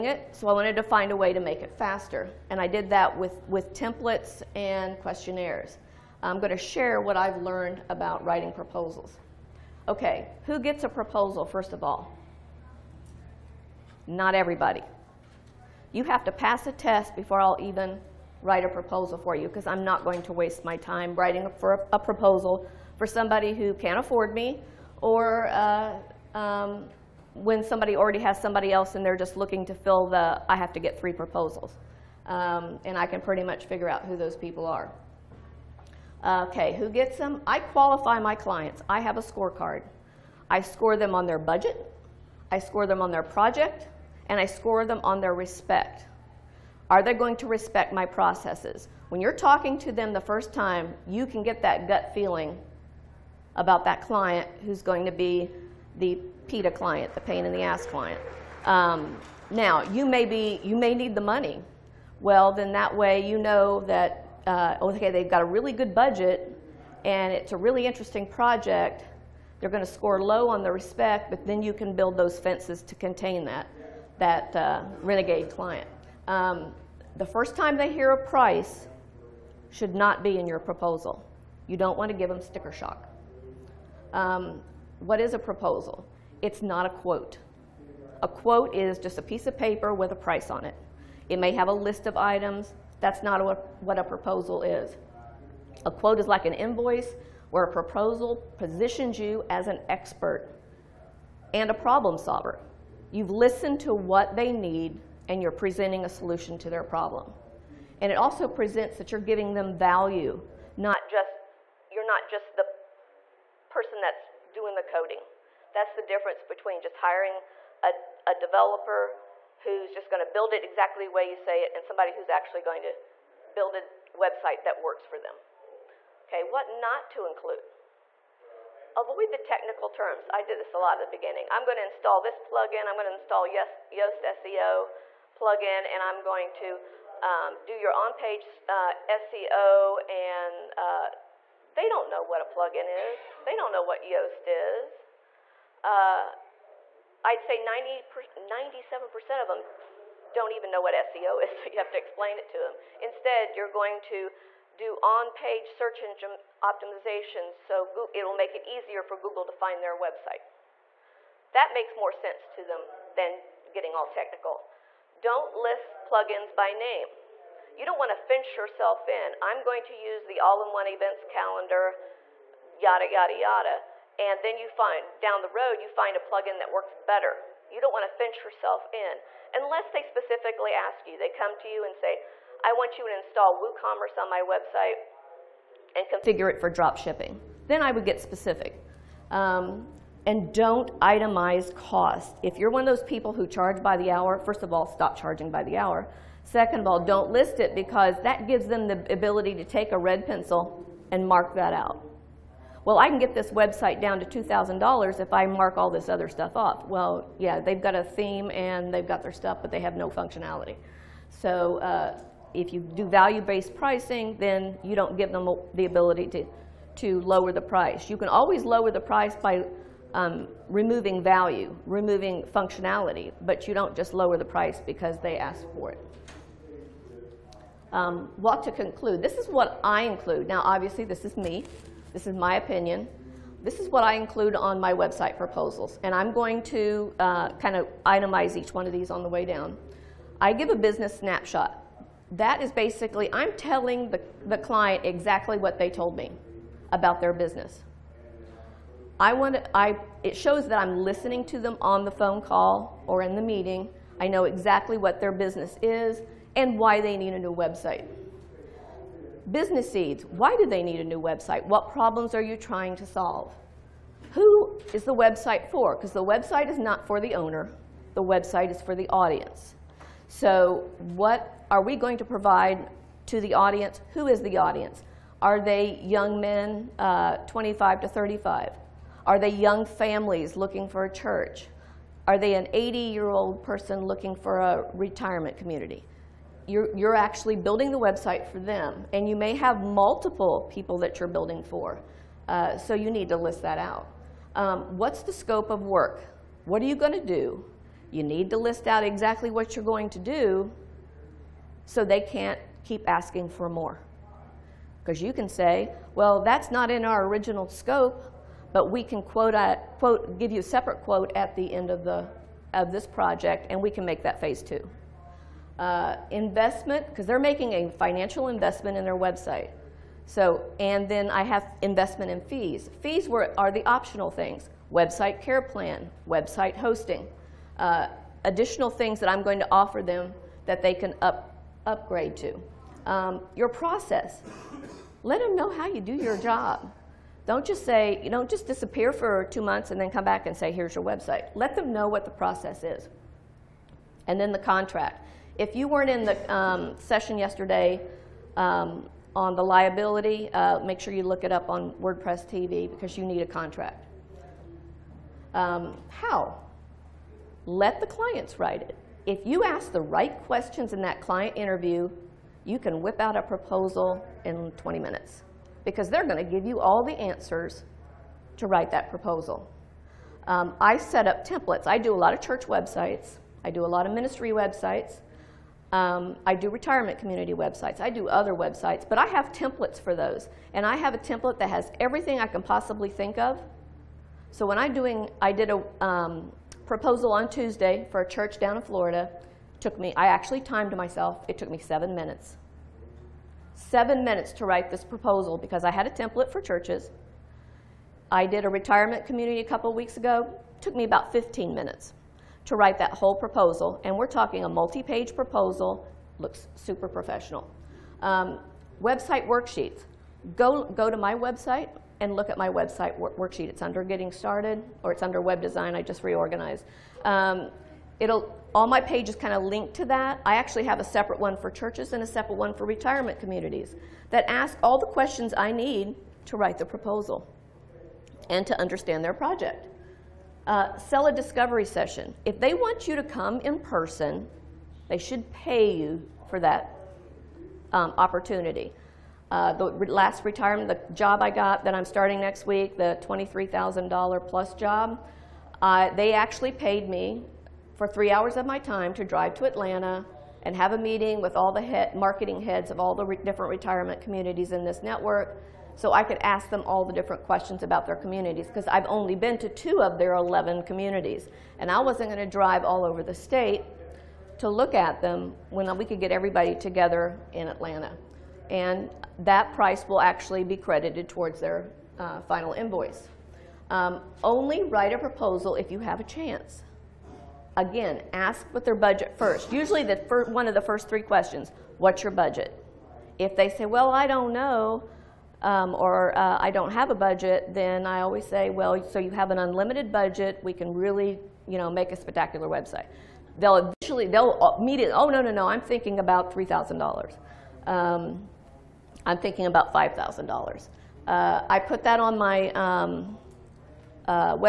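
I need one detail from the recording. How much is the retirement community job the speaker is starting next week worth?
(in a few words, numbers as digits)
$23,000.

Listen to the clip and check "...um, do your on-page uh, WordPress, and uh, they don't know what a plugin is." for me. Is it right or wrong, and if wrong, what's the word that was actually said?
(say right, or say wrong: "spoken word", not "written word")
wrong: "SEO", not "WordPress".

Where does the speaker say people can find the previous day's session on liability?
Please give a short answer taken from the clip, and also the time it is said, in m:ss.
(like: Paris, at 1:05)
WordPress TV, at 5:52.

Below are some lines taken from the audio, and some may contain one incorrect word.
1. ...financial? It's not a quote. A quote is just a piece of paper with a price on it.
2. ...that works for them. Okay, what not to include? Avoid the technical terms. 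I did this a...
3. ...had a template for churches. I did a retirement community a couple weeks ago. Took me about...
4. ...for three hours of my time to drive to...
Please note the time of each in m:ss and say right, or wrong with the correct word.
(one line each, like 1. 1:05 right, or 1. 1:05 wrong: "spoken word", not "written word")
1. 1:25 wrong: "proposal", not "financial"
2. 2:04 right
3. 6:35 right
4. 7:27 right.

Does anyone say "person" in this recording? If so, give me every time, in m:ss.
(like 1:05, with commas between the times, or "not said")
1:53, 4:43, 7:13.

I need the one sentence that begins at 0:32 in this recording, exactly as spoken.
Um, and I can pretty much figure out who those people are.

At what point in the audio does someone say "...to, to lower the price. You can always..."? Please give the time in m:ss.
3:36.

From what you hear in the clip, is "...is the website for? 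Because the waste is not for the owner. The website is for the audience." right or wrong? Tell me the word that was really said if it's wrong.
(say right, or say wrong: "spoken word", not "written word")
wrong: "website", not "waste".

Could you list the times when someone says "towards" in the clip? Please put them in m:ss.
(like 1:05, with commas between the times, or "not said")
7:51.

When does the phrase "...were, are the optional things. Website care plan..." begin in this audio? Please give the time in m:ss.
5:23.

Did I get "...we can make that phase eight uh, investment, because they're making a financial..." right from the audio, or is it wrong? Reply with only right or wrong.
wrong.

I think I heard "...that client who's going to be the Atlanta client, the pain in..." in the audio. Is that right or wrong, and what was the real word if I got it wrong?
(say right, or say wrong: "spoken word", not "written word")
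wrong: "PITA", not "Atlanta".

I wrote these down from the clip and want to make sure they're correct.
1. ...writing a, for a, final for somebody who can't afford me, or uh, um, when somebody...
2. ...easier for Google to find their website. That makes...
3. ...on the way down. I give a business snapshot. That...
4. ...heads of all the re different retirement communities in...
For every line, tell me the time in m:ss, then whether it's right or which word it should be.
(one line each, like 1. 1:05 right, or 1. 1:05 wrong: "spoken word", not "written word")
1. 0:21 wrong: "proposal", not "final"
2. 2:38 right
3. 3:59 right
4. 7:32 right.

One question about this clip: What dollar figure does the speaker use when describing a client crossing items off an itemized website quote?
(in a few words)
$2,000.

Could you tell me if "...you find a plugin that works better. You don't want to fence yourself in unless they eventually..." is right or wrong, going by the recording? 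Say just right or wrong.
wrong.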